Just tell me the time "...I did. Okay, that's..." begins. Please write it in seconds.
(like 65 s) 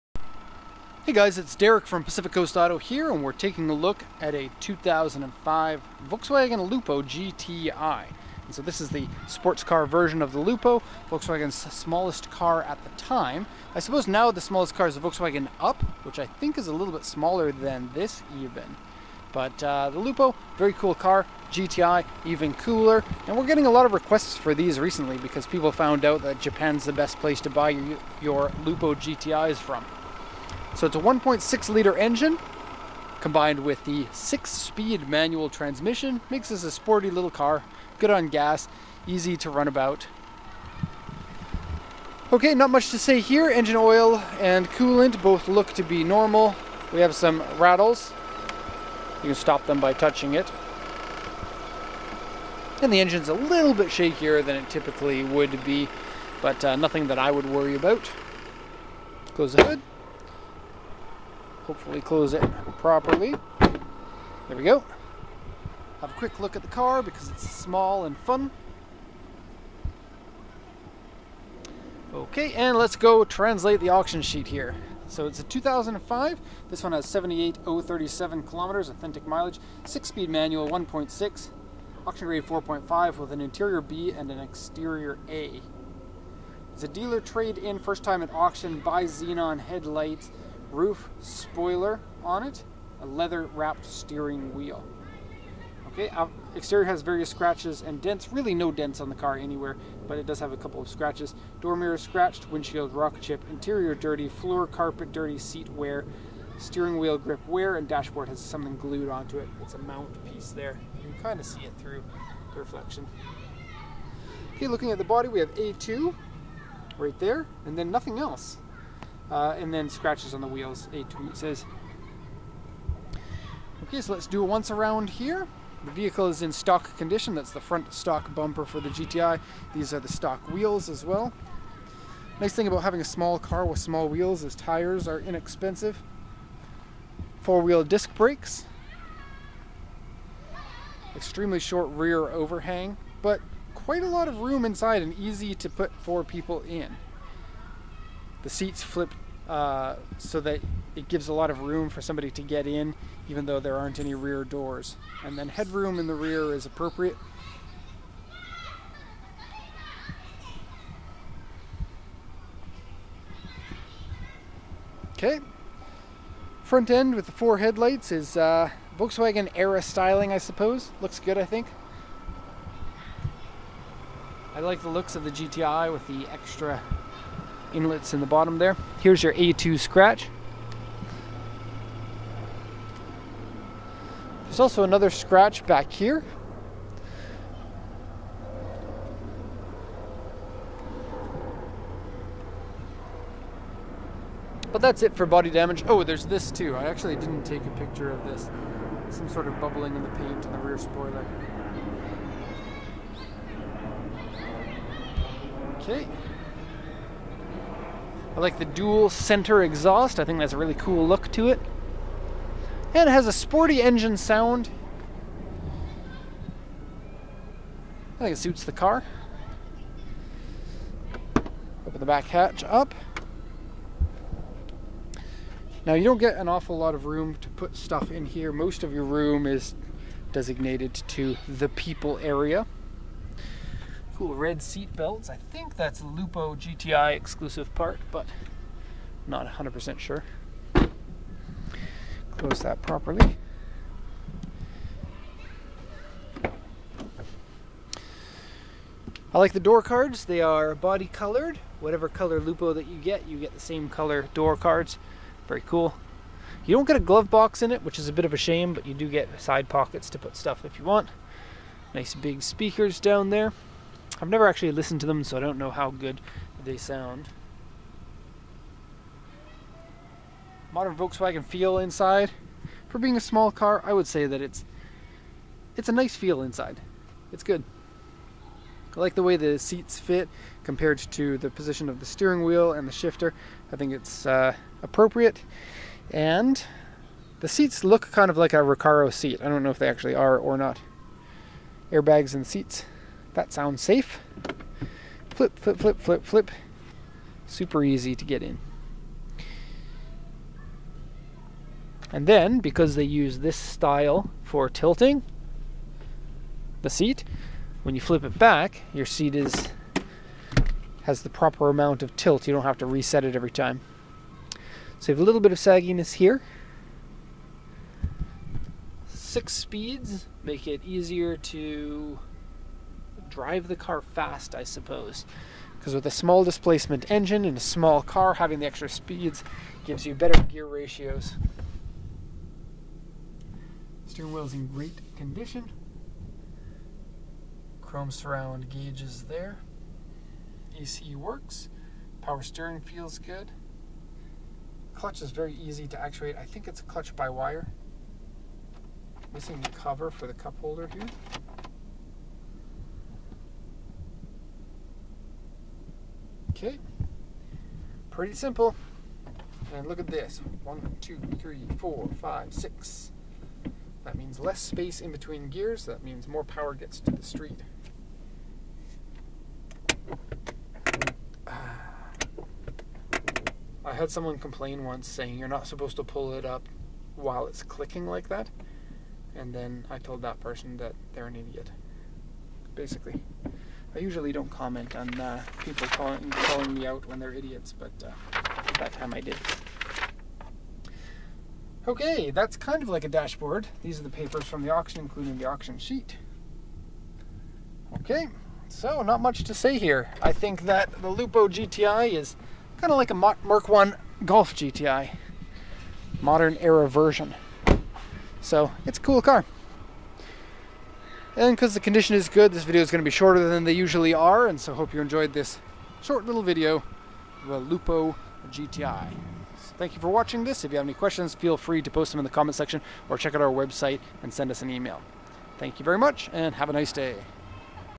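389 s.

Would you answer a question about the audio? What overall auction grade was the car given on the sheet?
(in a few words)
4.5.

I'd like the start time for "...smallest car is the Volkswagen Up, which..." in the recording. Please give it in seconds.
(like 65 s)
14 s.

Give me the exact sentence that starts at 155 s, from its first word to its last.
And then headroom in the rear is appropriate.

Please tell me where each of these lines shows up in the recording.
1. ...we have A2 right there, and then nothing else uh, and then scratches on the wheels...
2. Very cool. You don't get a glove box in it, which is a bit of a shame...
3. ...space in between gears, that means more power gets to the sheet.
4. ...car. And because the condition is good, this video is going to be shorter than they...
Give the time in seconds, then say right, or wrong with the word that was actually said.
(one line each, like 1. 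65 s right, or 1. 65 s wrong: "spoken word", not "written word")
1. 115 s right
2. 255 s right
3. 364 s wrong: "street", not "sheet"
4. 409 s right.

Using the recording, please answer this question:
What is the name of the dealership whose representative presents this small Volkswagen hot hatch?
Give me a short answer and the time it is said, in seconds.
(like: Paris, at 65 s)
Pacific Coast Auto, at 2 s.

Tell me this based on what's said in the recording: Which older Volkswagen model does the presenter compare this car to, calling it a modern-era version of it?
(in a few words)
Mark 1 Golf GTI.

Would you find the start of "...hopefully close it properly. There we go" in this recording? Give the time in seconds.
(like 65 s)
61 s.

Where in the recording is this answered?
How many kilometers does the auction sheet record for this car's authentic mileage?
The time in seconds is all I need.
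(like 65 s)
77 s.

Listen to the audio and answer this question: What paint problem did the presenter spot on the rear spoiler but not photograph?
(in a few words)
Bubbling.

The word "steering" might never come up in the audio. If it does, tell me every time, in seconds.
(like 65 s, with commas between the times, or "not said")
93 s, 106 s, 282 s, 334 s, 342 s.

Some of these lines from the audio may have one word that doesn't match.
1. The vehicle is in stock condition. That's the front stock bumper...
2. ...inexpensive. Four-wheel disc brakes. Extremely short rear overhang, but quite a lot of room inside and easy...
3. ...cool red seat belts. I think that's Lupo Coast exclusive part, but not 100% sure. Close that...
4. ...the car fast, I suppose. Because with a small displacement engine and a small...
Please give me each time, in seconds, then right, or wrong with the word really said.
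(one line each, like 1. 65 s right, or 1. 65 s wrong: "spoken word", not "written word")
1. 125 s right
2. 135 s right
3. 234 s wrong: "GTI", not "Coast"
4. 323 s right.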